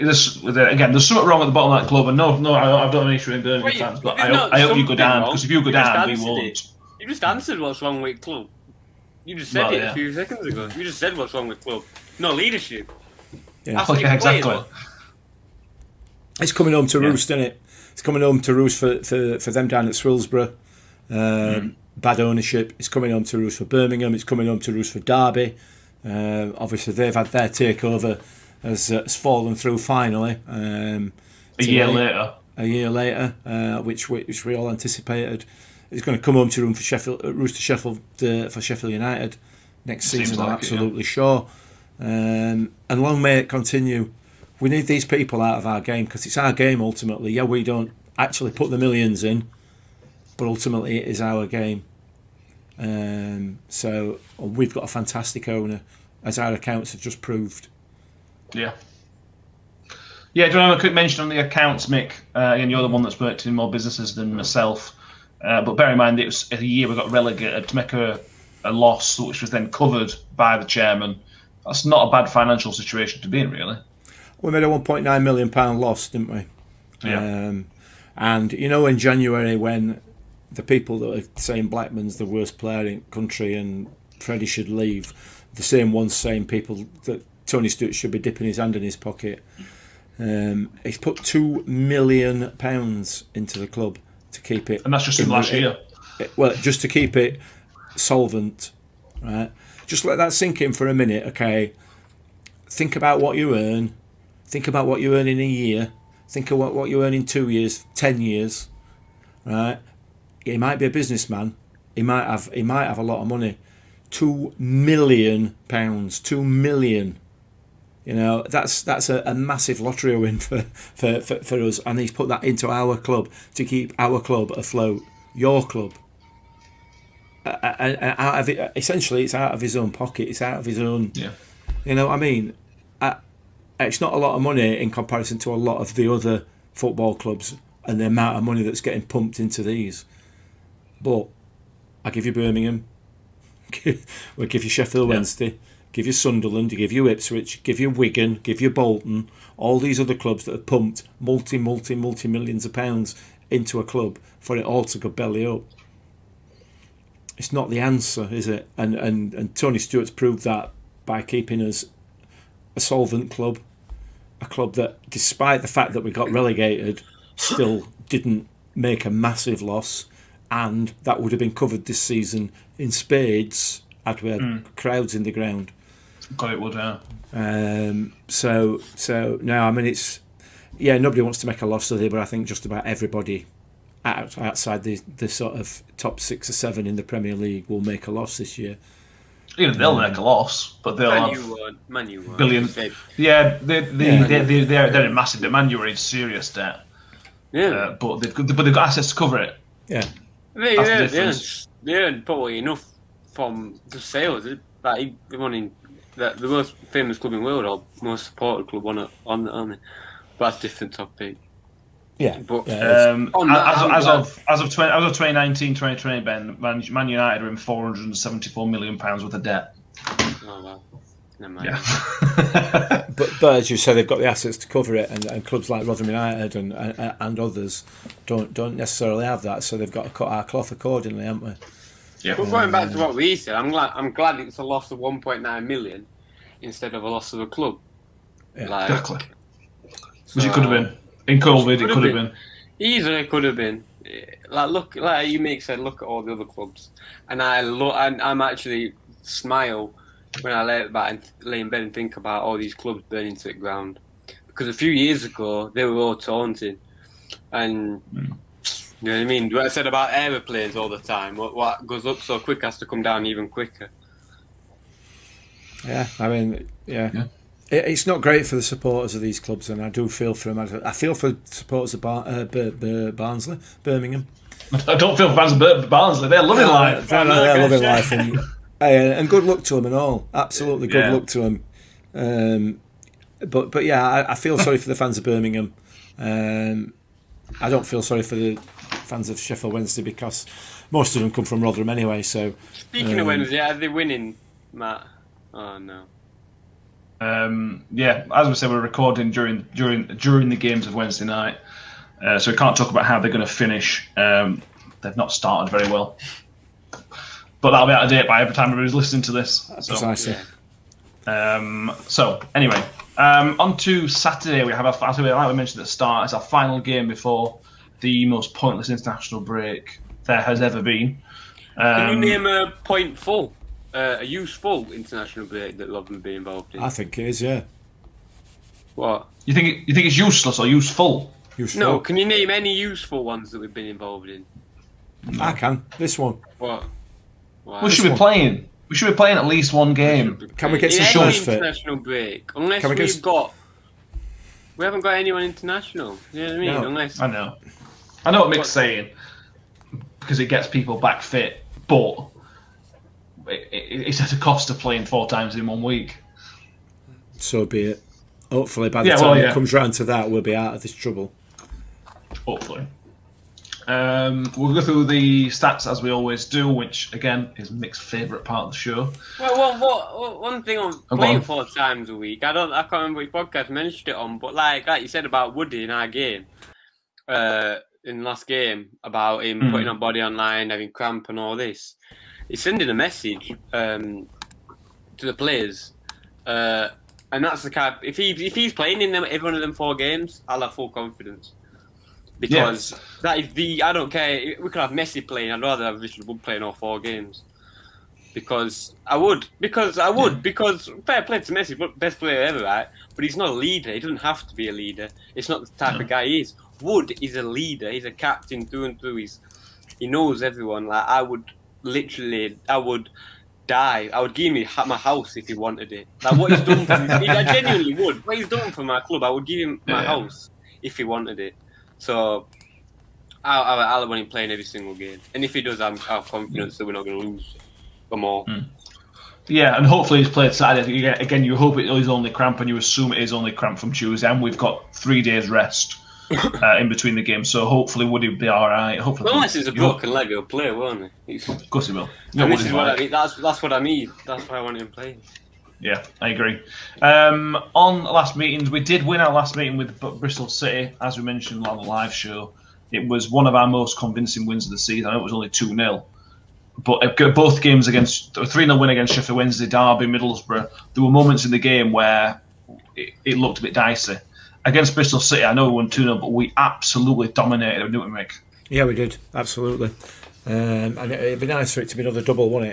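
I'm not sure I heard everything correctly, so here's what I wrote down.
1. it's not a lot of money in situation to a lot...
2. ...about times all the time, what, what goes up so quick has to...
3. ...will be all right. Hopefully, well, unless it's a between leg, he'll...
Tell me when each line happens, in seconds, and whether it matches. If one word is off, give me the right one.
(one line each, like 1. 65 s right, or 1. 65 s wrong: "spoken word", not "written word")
1. 133 s wrong: "comparison", not "situation"
2. 259 s wrong: "aeroplanes", not "times"
3. 438 s wrong: "broken", not "between".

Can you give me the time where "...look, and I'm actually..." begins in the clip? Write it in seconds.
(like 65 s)
247 s.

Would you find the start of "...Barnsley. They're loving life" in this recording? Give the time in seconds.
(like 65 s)
275 s.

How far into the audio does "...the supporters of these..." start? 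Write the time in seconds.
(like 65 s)
268 s.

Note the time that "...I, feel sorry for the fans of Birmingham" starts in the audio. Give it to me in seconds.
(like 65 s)
284 s.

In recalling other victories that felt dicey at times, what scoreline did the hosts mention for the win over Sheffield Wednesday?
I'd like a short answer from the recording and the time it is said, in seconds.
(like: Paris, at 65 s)
3-0, at 458 s.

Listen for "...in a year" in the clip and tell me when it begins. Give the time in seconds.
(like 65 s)
105 s.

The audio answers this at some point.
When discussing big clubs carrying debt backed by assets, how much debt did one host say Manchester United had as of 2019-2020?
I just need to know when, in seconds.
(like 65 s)
217 s.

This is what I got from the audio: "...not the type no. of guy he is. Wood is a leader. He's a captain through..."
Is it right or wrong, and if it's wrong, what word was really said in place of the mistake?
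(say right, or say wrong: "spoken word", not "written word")
right.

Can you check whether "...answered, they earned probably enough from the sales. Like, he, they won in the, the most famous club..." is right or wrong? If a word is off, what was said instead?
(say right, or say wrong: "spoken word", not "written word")
wrong: "earned", not "answered".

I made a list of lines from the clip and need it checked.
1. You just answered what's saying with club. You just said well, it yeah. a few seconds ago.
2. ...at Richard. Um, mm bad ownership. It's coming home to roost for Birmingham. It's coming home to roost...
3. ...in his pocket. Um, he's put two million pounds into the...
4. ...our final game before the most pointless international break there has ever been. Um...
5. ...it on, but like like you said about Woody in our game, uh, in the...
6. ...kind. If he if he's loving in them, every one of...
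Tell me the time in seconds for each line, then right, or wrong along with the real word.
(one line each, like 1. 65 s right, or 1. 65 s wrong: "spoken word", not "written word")
1. 6 s wrong: "wrong", not "saying"
2. 19 s wrong: "Swillsborough", not "Richard"
3. 88 s right
4. 316 s right
5. 374 s right
6. 387 s wrong: "playing", not "loving".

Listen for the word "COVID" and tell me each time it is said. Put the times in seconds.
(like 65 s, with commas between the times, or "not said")
241 s.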